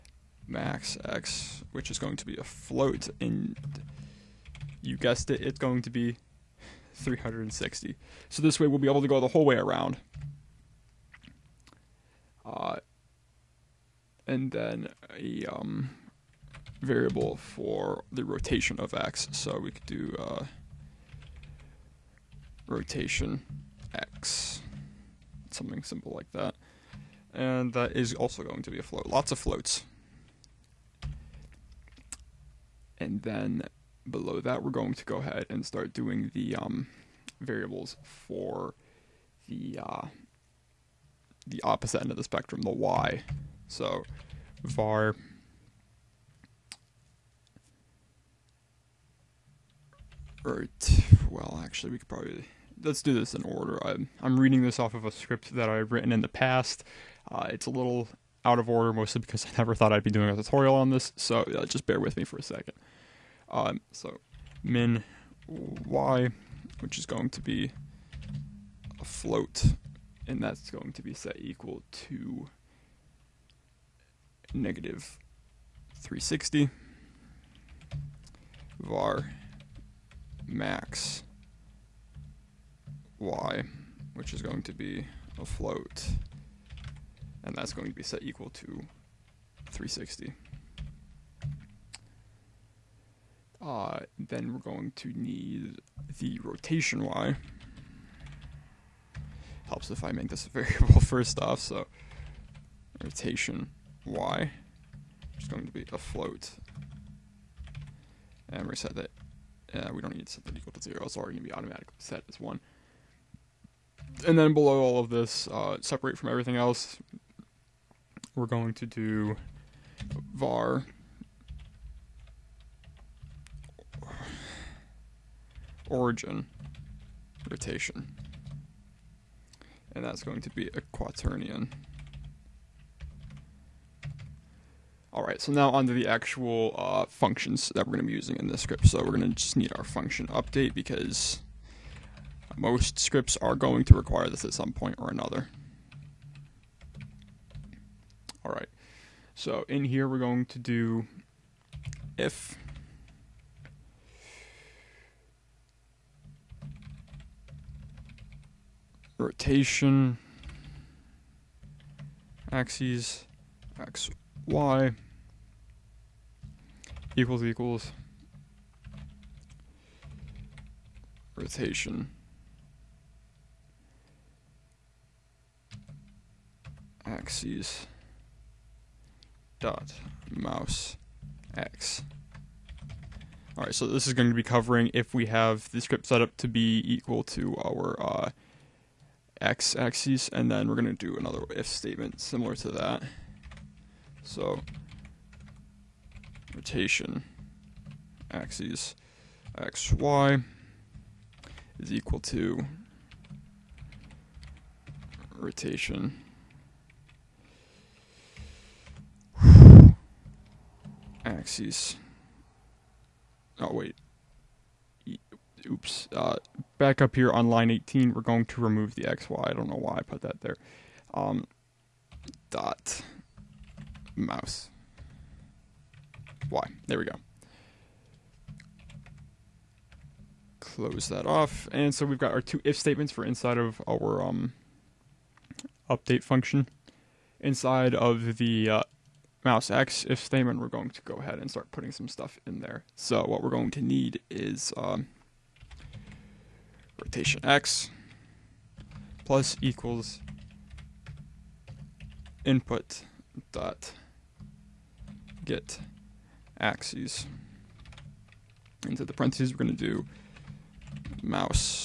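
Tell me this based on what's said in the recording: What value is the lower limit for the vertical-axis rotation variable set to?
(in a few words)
-360.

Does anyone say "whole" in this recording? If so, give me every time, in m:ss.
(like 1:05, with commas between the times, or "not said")
0:09.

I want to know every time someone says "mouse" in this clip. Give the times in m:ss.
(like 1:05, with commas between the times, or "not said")
3:00, 3:44, 3:59, 4:21.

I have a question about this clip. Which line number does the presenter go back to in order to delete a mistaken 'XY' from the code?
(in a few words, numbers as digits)
18.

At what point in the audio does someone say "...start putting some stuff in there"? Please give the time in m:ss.
4:01.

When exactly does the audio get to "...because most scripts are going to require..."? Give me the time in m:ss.
2:20.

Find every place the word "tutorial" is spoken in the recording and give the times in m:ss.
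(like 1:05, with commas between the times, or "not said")
1:00.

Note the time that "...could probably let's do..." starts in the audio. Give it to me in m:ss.
0:51.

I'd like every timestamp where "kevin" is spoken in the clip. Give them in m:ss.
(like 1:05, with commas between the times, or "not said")
not said.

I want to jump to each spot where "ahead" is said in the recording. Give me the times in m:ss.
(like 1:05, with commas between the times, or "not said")
0:35, 4:01.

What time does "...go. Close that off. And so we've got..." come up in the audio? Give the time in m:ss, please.
3:47.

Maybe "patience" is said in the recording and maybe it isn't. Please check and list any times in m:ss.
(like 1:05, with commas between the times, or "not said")
not said.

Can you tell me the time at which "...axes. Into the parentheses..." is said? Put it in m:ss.
4:16.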